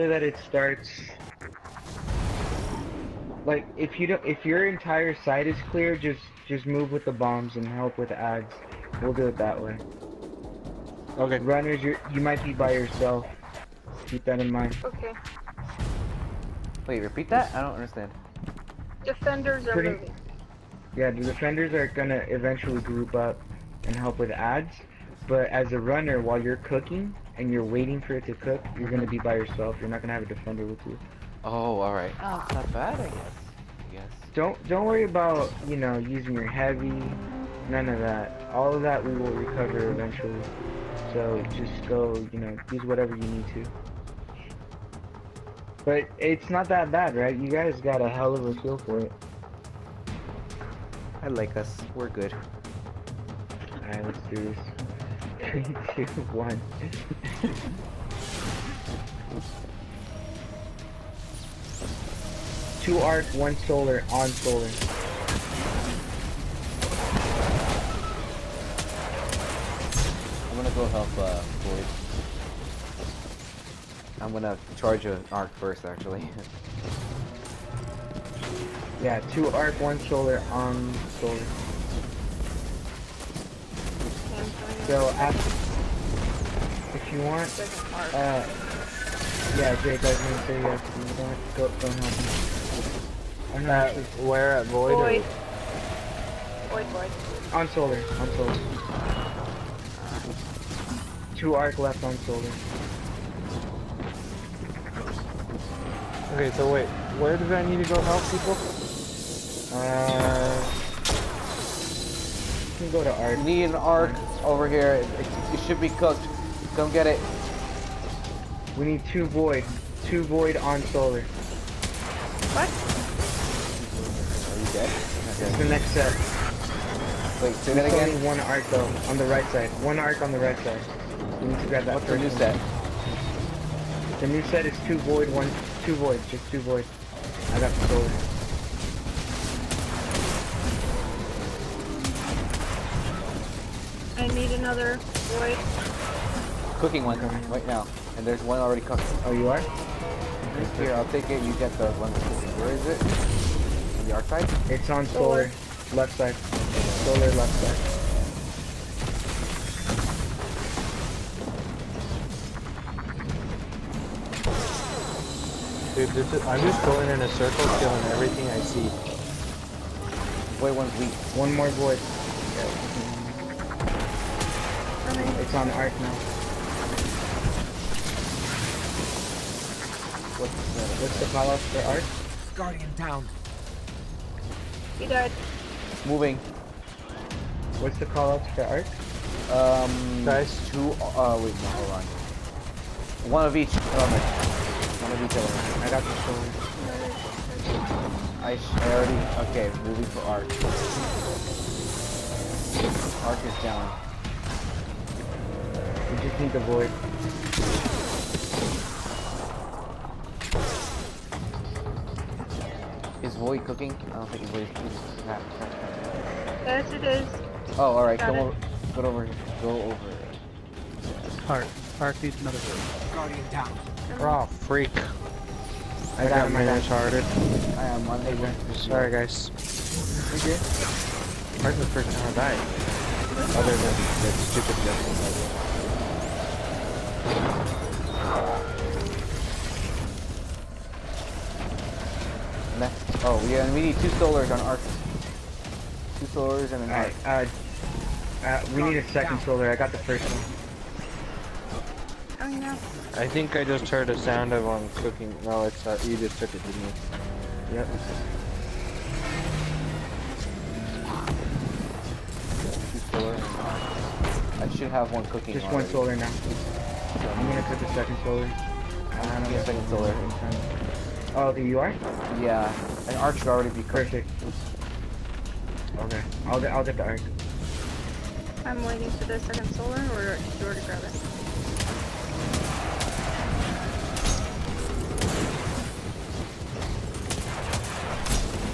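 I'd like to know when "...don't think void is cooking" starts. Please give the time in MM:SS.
03:34.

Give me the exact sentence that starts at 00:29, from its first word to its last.
You're not gonna have a defender with you.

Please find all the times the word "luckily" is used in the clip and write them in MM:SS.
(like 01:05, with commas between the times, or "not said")
not said.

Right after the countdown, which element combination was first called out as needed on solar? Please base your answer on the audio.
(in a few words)
Two arc, one solar.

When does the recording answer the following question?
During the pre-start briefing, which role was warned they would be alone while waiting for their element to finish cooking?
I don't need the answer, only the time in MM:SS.
00:25.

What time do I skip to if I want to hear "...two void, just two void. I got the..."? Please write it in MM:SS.
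02:15.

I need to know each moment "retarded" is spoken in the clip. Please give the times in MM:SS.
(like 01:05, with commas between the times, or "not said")
03:46.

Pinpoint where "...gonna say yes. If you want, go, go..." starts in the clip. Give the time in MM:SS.
01:30.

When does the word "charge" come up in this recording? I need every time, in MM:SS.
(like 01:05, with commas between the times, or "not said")
01:14.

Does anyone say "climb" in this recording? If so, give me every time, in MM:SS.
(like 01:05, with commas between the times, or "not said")
not said.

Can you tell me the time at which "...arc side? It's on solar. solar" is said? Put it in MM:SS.
02:34.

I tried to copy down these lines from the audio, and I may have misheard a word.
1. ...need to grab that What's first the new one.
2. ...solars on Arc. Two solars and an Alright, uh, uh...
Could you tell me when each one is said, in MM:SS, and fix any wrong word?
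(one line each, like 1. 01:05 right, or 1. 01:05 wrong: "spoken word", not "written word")
1. 02:11 right
2. 04:04 right.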